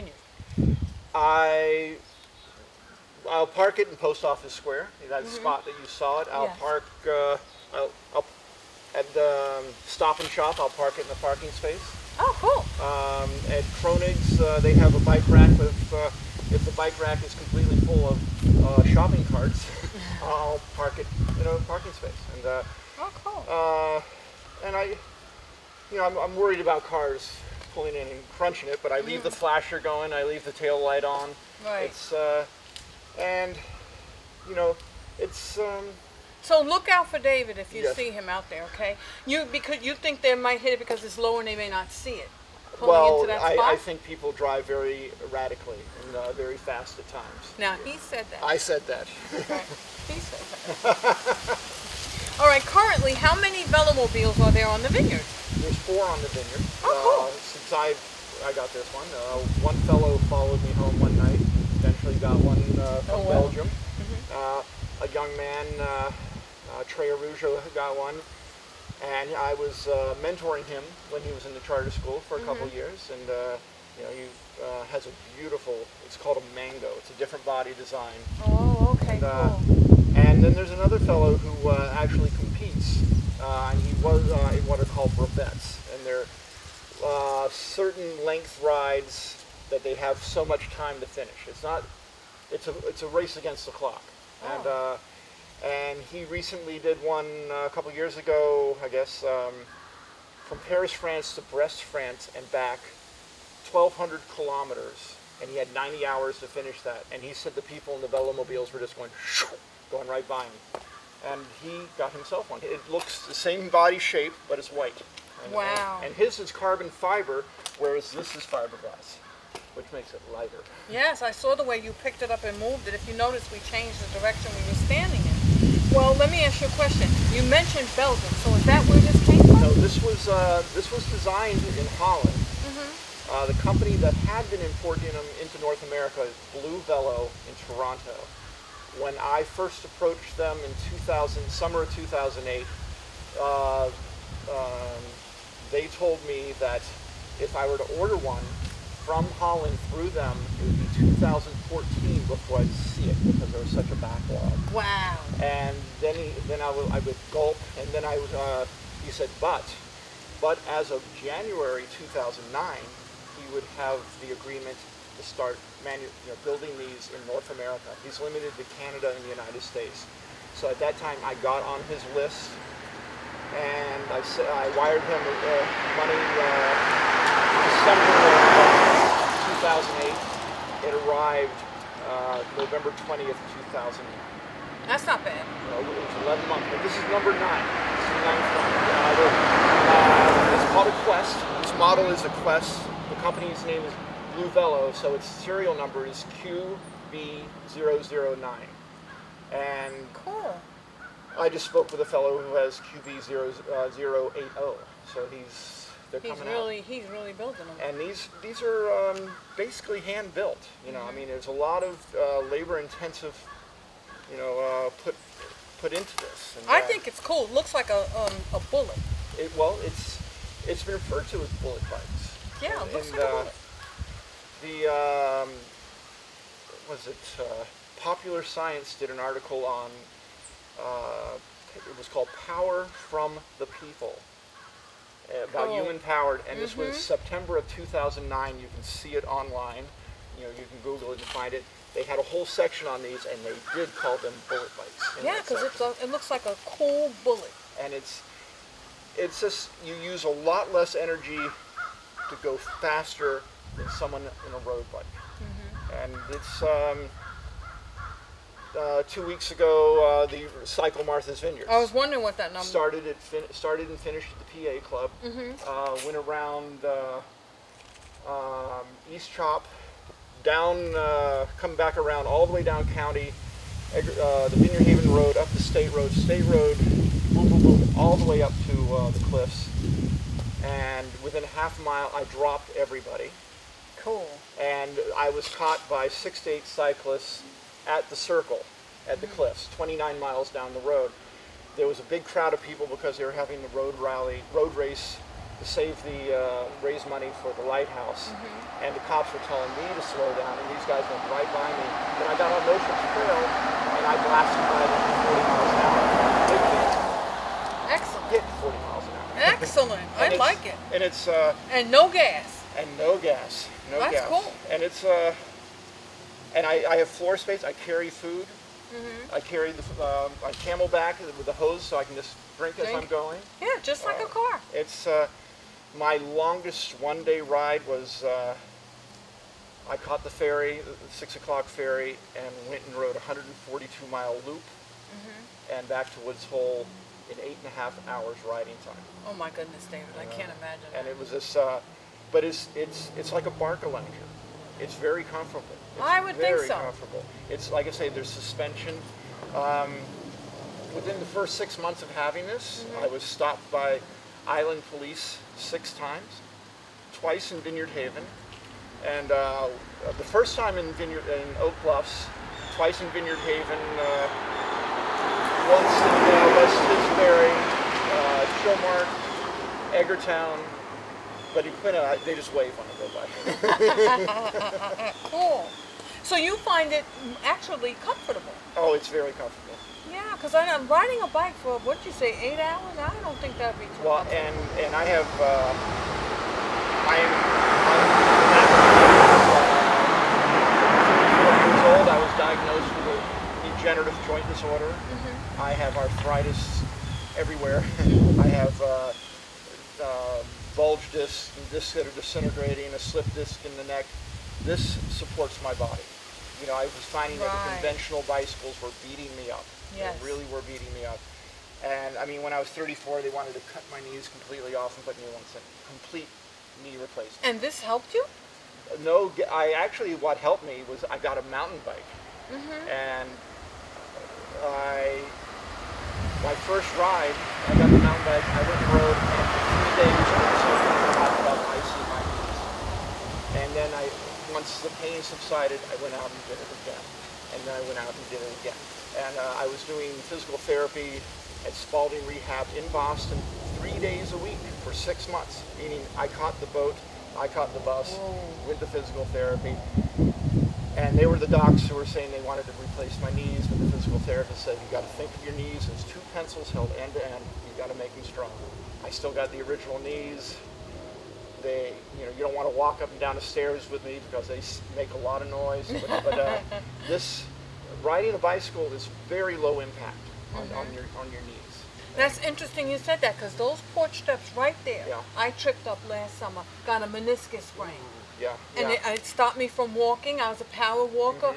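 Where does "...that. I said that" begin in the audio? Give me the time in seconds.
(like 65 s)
48 s.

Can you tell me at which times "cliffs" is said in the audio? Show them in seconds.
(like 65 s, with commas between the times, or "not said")
279 s, 289 s.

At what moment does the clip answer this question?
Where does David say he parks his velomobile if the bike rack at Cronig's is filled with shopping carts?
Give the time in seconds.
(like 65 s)
20 s.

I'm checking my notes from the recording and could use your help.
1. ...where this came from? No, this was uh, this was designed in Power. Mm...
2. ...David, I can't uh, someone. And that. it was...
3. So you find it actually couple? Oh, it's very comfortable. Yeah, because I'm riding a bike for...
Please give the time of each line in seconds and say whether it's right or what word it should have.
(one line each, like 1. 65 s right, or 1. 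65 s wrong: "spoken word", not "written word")
1. 128 s wrong: "Holland", not "Power"
2. 339 s wrong: "imagine", not "someone"
3. 376 s wrong: "comfortable", not "couple".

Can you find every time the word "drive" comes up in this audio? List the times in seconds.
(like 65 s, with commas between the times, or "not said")
44 s.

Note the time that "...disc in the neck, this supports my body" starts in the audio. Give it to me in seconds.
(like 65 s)
403 s.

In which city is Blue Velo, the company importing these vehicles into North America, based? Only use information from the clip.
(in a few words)
Toronto.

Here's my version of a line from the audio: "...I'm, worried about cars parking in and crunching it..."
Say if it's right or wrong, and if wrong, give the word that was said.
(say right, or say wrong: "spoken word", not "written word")
wrong: "pulling", not "parking".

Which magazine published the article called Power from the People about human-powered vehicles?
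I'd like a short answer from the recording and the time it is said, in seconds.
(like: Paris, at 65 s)
Popular Science, at 228 s.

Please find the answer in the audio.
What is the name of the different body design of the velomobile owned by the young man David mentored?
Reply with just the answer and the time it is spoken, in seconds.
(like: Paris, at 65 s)
mango, at 76 s.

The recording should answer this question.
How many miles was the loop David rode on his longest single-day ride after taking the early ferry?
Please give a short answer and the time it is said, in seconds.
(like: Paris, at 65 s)
142, at 333 s.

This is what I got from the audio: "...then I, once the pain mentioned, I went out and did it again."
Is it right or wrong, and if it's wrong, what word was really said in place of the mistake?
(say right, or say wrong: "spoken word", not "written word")
wrong: "subsided", not "mentioned".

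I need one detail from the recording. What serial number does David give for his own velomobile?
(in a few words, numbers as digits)
QB009.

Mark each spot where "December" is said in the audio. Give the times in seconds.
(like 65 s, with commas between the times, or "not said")
177 s.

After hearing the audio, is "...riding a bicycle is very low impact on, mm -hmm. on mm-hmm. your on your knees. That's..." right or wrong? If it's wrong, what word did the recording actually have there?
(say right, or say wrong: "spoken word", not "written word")
right.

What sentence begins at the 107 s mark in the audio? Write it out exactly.
And he said the people in the velomobiles were just going, going right by him.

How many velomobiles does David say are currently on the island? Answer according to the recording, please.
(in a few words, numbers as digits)
4.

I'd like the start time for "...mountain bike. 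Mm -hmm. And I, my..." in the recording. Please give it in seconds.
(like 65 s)
421 s.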